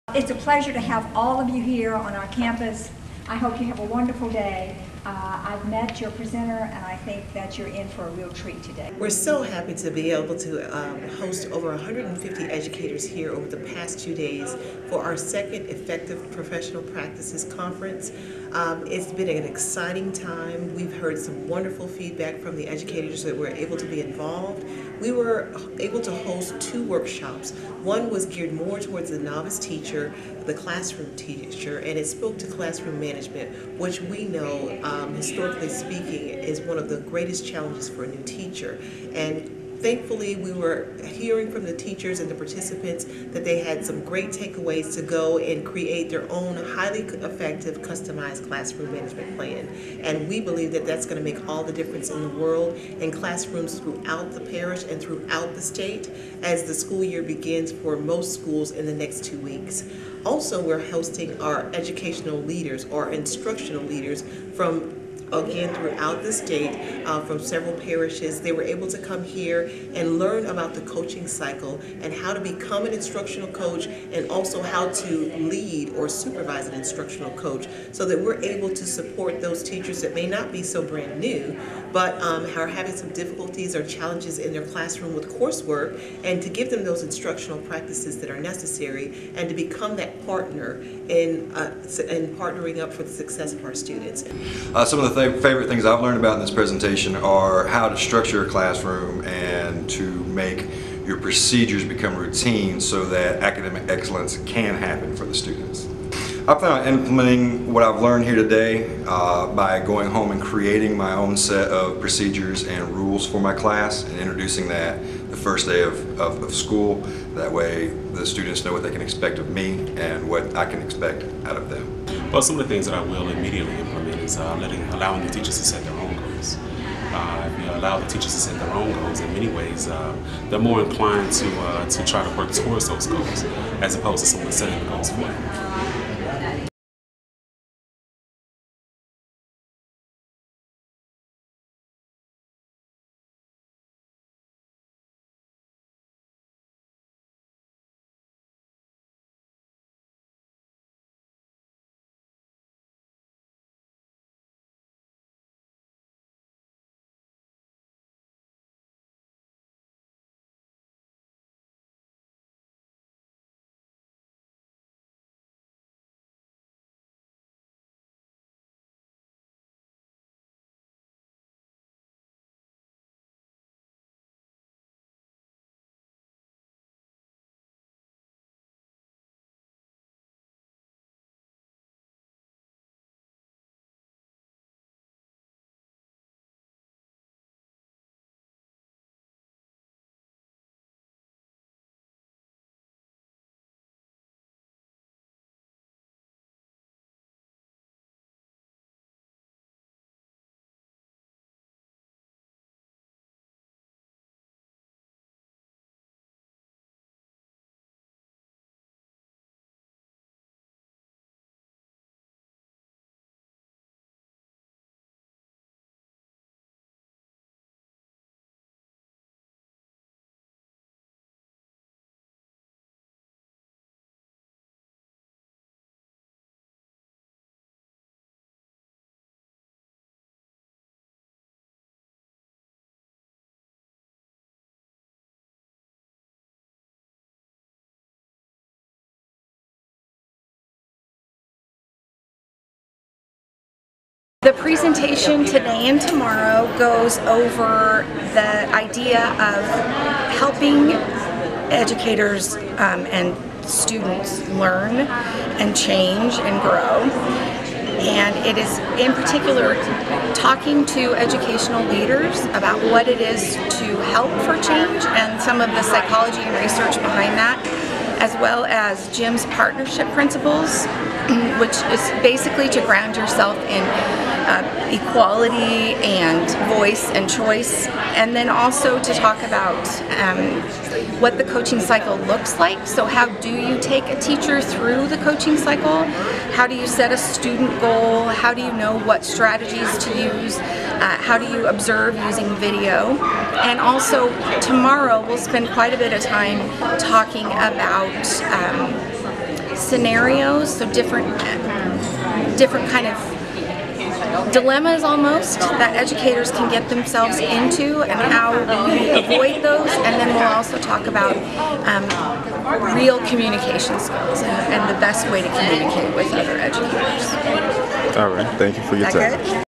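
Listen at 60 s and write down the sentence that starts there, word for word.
Also, we're hosting our educational leaders, our instructional leaders from again throughout the state uh, from several parishes.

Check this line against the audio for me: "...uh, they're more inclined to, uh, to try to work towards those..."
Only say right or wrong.
right.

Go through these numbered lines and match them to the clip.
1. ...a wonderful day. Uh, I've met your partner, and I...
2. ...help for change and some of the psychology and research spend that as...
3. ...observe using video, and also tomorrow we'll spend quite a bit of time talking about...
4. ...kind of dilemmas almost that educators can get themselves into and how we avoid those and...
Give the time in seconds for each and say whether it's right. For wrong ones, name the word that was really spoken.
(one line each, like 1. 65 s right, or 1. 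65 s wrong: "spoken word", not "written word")
1. 3 s wrong: "presenter", not "partner"
2. 264 s wrong: "behind", not "spend"
3. 291 s right
4. 302 s right.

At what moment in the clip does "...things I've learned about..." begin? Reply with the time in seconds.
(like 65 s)
95 s.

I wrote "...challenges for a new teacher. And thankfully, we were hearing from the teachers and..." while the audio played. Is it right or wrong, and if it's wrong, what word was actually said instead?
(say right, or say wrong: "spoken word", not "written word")
right.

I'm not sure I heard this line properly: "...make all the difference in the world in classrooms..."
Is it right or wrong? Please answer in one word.
right.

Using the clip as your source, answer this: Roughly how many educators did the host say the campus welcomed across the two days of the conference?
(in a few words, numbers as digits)
150.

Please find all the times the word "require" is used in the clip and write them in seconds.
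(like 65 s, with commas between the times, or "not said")
not said.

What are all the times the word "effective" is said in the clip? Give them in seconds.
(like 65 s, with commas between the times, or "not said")
15 s, 47 s.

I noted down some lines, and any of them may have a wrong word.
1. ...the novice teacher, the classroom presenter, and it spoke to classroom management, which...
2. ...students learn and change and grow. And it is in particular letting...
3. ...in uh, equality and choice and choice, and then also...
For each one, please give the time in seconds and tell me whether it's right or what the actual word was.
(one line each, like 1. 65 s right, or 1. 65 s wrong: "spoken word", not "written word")
1. 29 s wrong: "teacher", not "presenter"
2. 253 s wrong: "talking", not "letting"
3. 273 s wrong: "voice", not "choice".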